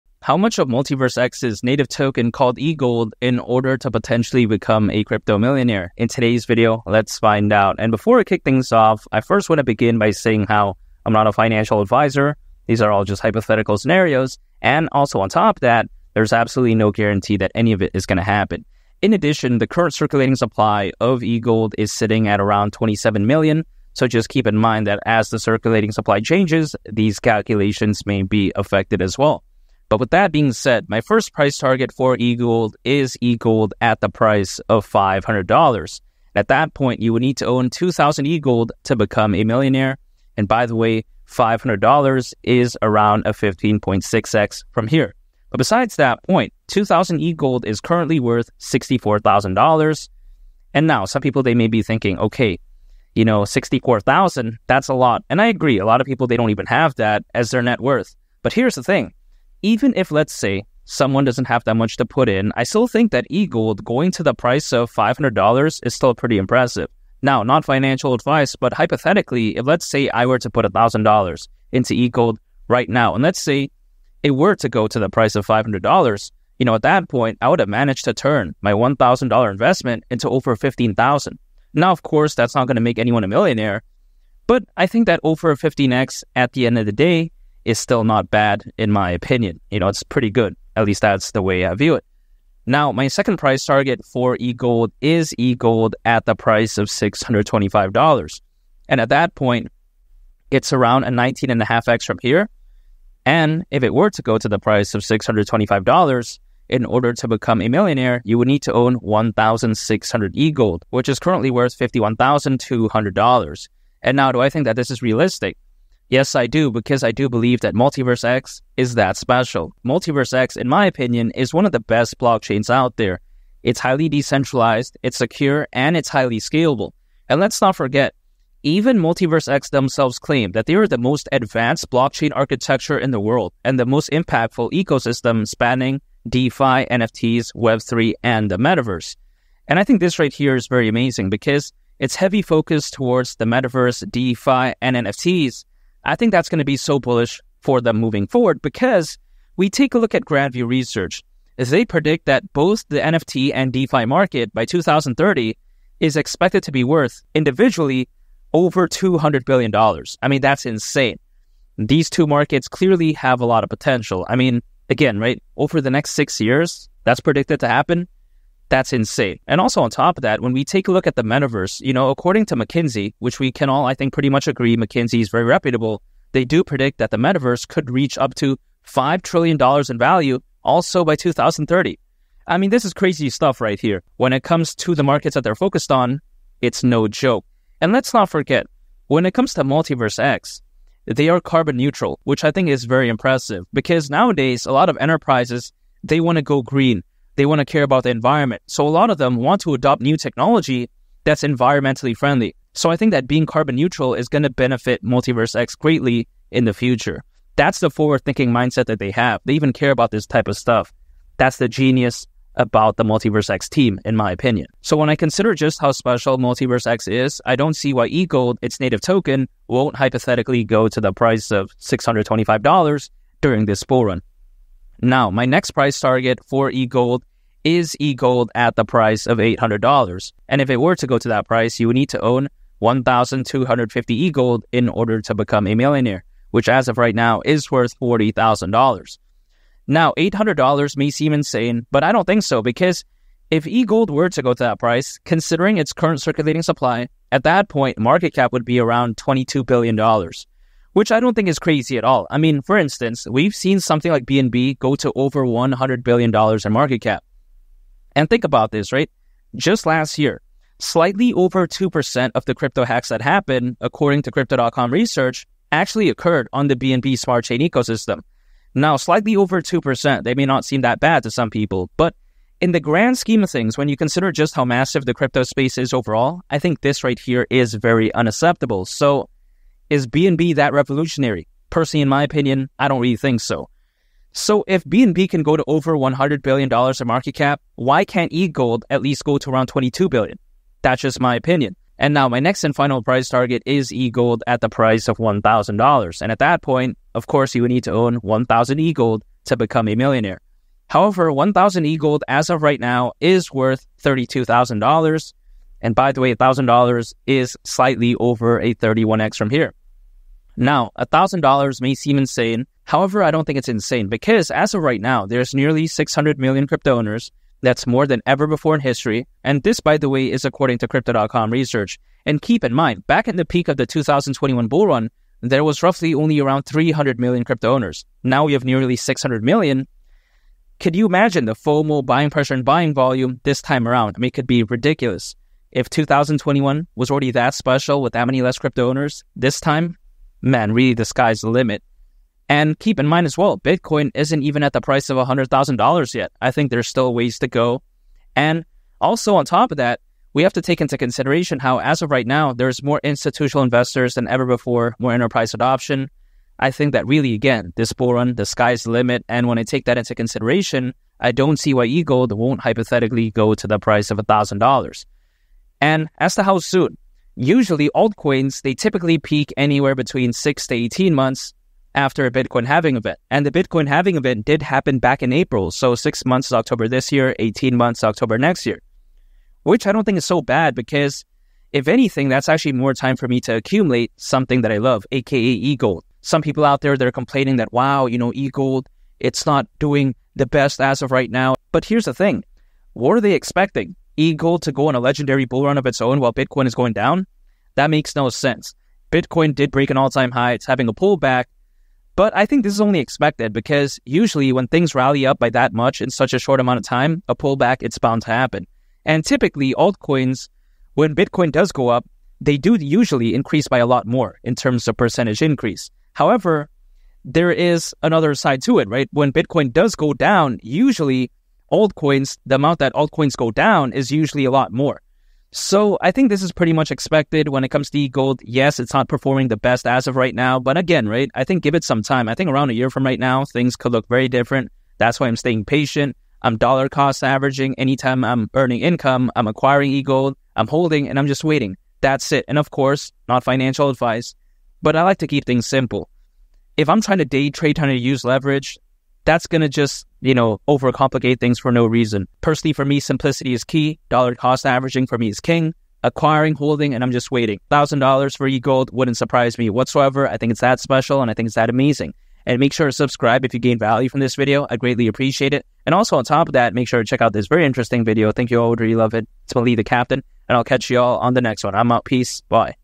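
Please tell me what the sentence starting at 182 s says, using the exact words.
I mean, this is crazy stuff right here.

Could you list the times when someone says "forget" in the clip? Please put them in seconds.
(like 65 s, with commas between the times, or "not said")
127 s, 188 s.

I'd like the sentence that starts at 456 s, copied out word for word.
Acquiring, holding, and I'm just waiting.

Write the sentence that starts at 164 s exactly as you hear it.
I mean, again, right, over the next six years, that's predicted to happen.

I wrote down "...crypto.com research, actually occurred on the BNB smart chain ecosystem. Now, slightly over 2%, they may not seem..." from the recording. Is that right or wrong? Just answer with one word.
right.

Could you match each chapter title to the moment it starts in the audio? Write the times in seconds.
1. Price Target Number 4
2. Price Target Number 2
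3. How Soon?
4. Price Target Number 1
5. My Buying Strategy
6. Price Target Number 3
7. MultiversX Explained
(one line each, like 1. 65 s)
1. 291 s
2. 95 s
3. 367 s
4. 32 s
5. 436 s
6. 224 s
7. 119 s.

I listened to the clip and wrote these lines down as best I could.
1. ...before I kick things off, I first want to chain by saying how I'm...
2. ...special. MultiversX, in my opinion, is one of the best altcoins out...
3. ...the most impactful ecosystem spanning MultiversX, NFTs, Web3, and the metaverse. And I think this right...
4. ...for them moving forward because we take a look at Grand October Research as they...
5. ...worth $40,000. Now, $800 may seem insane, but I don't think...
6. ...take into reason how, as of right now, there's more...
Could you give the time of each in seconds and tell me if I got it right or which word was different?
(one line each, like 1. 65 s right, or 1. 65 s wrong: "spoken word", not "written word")
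1. 7 s wrong: "begin", not "chain"
2. 119 s wrong: "blockchains", not "altcoins"
3. 133 s wrong: "DeFi", not "MultiversX"
4. 147 s wrong: "View", not "October"
5. 237 s right
6. 350 s wrong: "consideration", not "reason".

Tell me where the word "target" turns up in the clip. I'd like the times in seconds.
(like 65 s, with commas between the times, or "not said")
31 s, 93 s, 225 s, 293 s.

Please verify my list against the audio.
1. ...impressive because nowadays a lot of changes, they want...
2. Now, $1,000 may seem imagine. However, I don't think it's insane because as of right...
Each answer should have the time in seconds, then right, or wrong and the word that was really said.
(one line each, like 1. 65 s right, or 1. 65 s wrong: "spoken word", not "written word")
1. 193 s wrong: "enterprises", not "changes"
2. 310 s wrong: "insane", not "imagine".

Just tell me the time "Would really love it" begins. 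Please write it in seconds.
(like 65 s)
468 s.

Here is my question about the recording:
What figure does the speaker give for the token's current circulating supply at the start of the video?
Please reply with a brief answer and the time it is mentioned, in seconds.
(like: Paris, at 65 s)
27 million, at 22 s.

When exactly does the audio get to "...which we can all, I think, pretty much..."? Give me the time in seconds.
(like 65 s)
173 s.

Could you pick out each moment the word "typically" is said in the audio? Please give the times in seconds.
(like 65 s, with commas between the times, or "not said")
368 s, 409 s.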